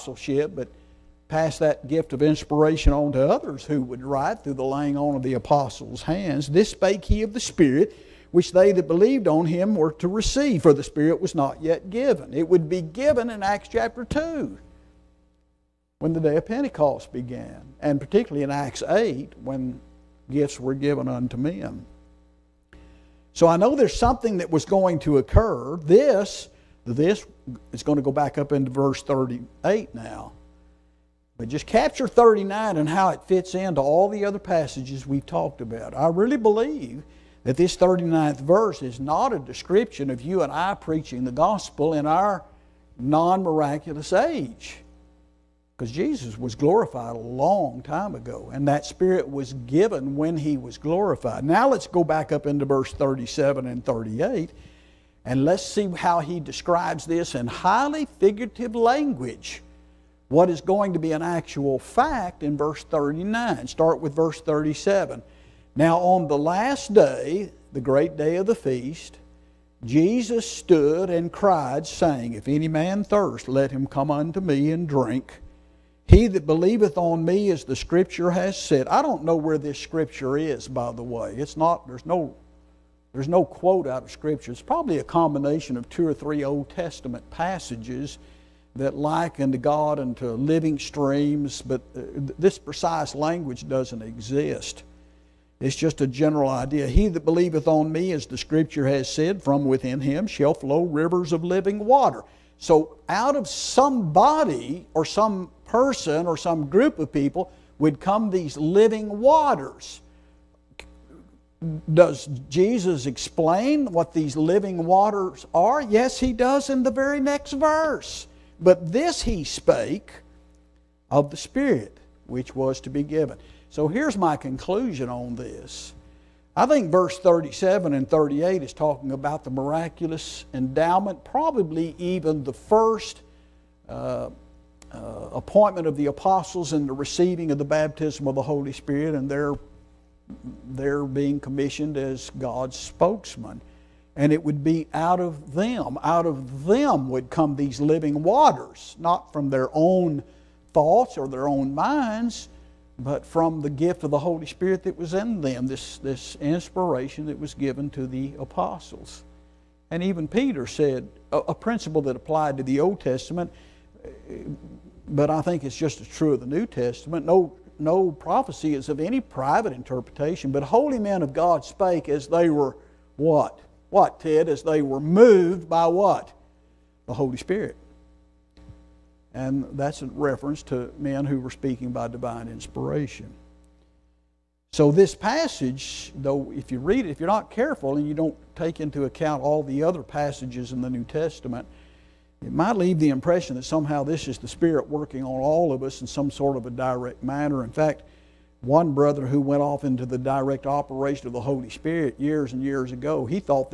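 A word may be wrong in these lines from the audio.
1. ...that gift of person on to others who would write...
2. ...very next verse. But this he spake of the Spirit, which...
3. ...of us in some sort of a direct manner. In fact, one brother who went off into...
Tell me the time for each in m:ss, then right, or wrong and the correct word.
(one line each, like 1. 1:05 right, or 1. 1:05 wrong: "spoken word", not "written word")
1. 0:01 wrong: "inspiration", not "person"
2. 1:56 right
3. 3:15 right.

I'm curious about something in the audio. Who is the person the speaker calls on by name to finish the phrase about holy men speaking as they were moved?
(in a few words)
Ted.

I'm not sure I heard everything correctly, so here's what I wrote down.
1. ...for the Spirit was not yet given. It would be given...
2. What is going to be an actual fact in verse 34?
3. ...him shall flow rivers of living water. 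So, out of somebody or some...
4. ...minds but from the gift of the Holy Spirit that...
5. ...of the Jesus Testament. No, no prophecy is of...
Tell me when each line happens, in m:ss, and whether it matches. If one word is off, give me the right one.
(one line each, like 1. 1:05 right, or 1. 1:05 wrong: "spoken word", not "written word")
1. 0:10 right
2. 1:00 wrong: "39", not "34"
3. 1:39 right
4. 2:31 right
5. 2:46 wrong: "New", not "Jesus".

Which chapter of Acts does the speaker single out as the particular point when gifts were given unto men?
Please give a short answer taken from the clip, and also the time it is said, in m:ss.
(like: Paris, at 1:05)
Acts 8, at 0:18.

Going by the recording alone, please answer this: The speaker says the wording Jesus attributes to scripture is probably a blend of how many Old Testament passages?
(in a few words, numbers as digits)
2 or 3.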